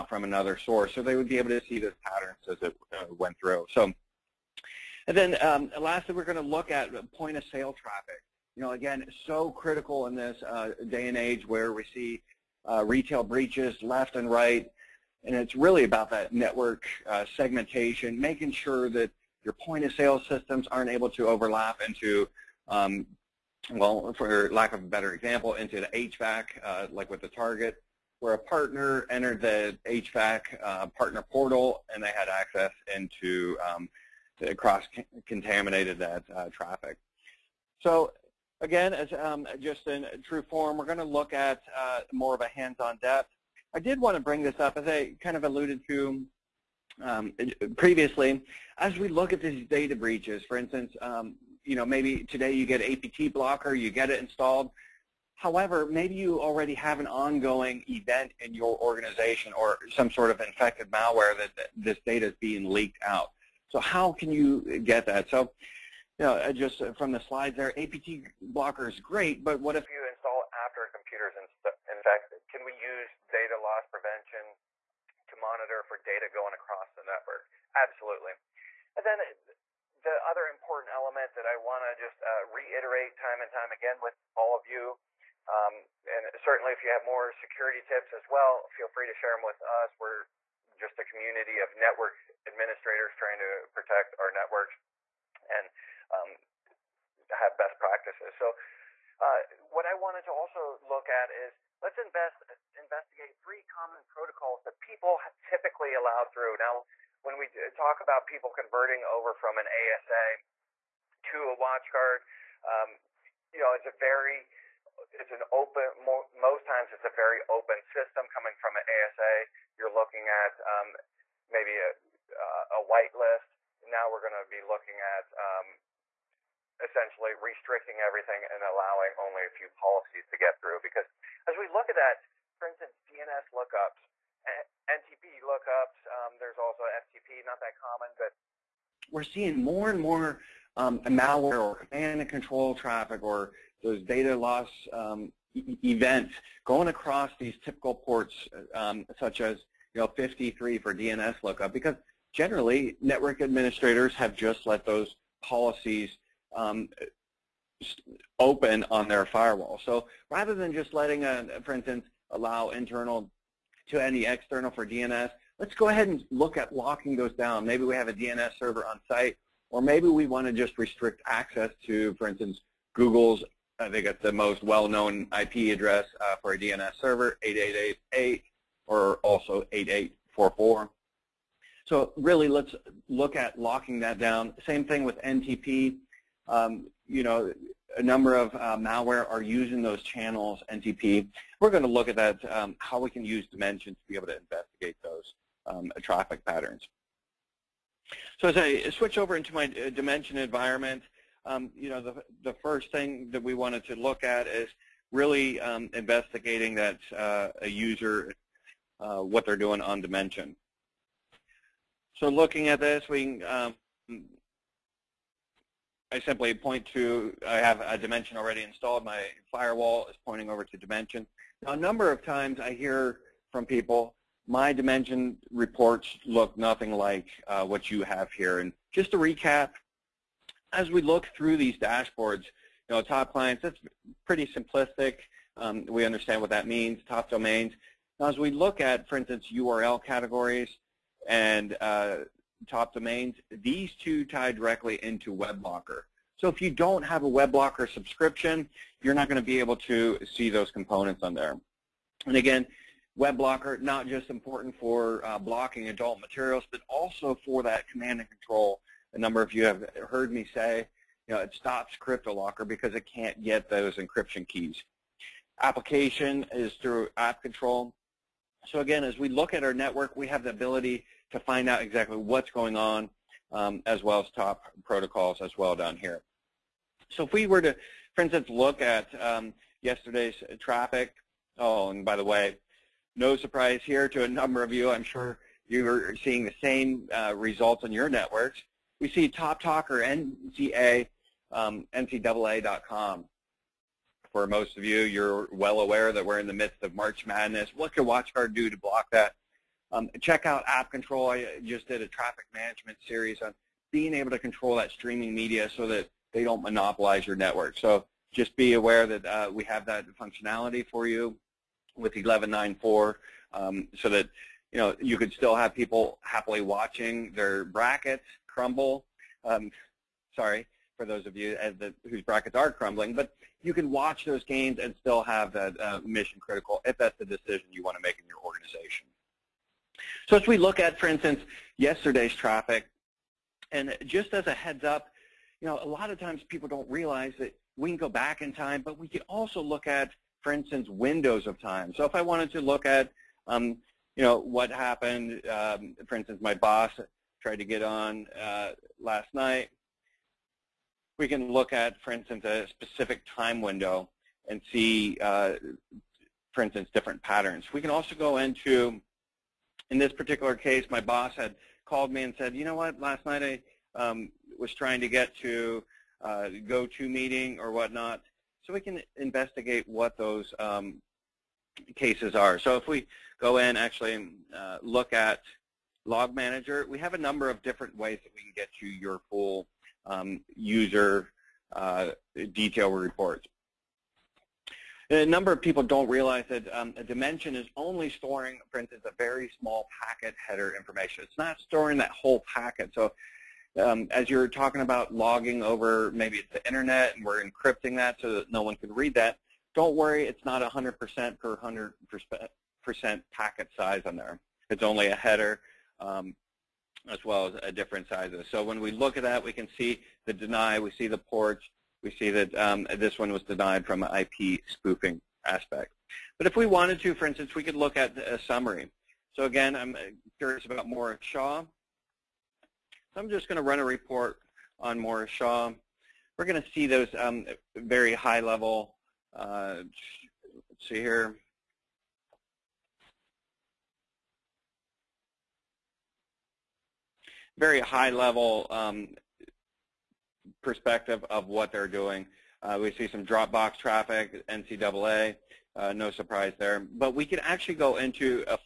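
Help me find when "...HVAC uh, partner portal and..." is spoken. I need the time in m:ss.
0:29.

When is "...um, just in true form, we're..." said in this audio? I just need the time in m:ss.
0:39.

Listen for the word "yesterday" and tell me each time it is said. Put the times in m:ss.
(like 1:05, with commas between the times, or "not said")
4:39, 5:31.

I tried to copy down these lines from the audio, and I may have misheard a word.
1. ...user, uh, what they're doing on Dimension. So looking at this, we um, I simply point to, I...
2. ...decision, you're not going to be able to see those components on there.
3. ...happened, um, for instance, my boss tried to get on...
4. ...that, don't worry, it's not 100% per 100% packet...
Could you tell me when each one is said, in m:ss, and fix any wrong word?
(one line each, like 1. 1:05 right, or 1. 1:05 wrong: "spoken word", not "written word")
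1. 3:27 right
2. 4:07 wrong: "subscription", not "decision"
3. 5:44 right
4. 6:39 right.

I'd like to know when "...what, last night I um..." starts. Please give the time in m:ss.
6:02.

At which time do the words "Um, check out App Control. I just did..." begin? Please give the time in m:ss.
4:59.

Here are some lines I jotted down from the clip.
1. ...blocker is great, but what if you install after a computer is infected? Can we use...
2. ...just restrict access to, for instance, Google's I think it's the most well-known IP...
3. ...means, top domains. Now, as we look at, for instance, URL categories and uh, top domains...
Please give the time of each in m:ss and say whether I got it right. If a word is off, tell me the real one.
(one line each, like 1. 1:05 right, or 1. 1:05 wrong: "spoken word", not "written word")
1. 1:08 right
2. 2:50 right
3. 3:56 right.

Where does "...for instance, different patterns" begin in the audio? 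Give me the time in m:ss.
5:56.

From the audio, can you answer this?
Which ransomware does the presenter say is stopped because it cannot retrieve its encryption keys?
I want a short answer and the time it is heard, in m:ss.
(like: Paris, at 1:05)
CryptoLocker, at 4:22.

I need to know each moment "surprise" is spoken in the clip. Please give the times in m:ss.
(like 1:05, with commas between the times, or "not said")
4:43, 7:26.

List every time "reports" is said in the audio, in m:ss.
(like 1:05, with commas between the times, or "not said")
3:45, 6:22, 7:03.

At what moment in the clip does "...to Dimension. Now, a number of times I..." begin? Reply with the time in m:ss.
3:40.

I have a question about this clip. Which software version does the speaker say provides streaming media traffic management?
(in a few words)
11.9.4.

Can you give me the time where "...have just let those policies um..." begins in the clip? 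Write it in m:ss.
2:34.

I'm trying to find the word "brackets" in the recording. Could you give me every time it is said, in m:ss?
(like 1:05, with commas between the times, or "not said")
5:17, 5:22.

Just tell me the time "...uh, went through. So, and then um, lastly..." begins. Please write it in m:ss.
0:02.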